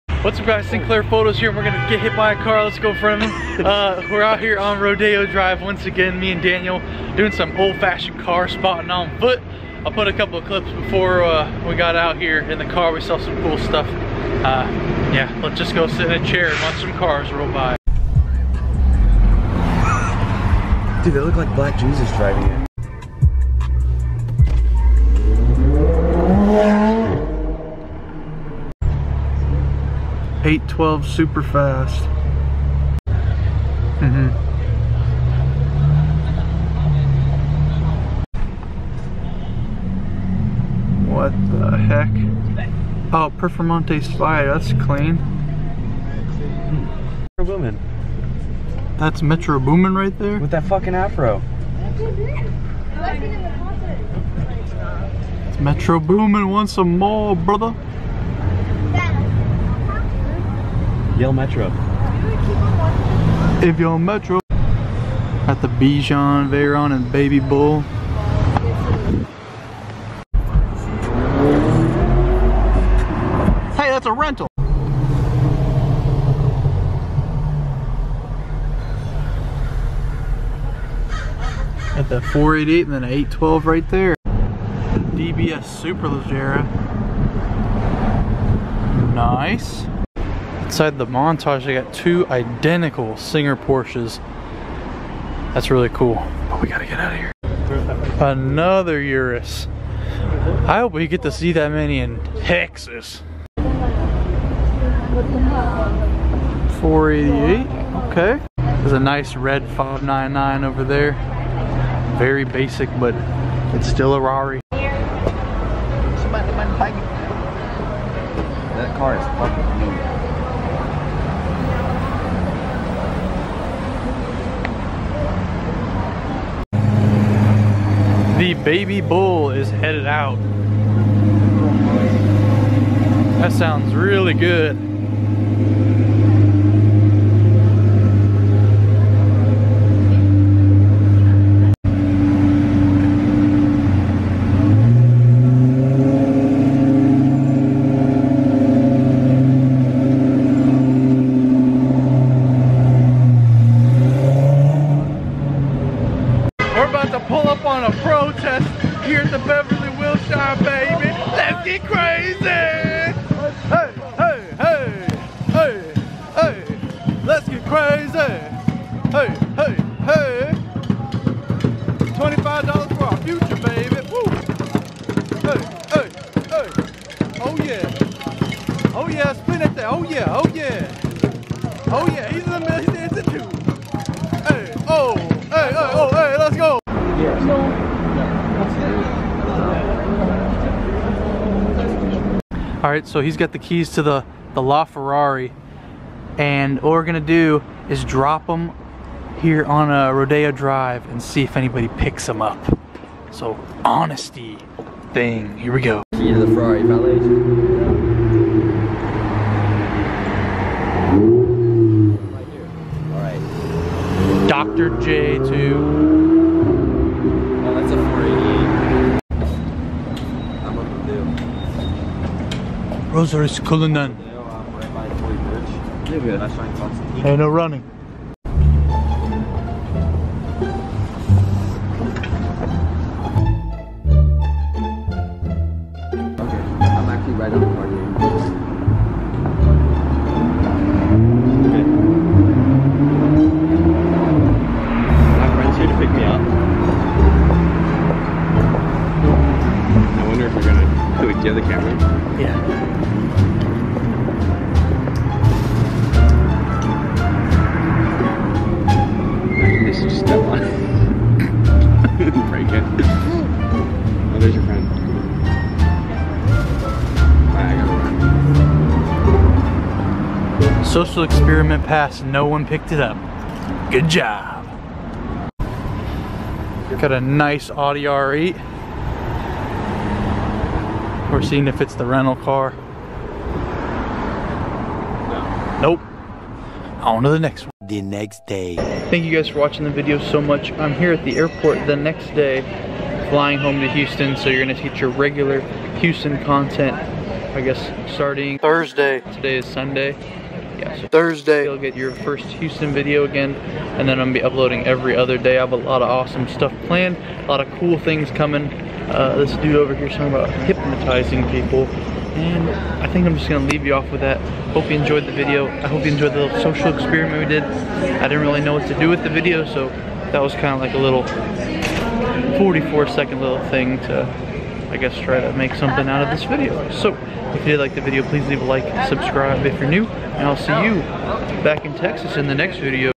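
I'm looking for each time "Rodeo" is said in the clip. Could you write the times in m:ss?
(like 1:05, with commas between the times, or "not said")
0:04, 3:20.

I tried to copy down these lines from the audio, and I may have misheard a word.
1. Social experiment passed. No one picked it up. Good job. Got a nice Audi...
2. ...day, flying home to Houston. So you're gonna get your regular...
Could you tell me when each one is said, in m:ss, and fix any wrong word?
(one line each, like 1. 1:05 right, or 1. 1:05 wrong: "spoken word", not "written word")
1. 4:30 right
2. 4:52 right.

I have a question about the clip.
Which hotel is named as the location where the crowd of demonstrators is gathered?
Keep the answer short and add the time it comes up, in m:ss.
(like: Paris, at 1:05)
Beverly Wilshire, at 2:39.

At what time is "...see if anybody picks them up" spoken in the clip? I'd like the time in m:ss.
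3:21.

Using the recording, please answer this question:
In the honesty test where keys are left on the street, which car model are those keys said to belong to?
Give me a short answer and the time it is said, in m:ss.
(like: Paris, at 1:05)
LaFerrari, at 3:14.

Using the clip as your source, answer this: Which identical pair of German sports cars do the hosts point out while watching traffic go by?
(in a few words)
Singer Porsches.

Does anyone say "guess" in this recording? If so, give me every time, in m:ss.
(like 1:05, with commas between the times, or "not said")
4:57, 5:24.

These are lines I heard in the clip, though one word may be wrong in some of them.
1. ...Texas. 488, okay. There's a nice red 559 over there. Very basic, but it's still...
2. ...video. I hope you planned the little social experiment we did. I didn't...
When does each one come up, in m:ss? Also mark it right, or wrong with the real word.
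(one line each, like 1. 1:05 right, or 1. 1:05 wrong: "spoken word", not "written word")
1. 1:42 wrong: "599", not "559"
2. 5:15 wrong: "enjoyed", not "planned".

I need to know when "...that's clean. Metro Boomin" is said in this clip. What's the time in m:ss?
0:44.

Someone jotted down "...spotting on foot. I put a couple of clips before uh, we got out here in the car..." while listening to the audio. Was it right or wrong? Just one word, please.
right.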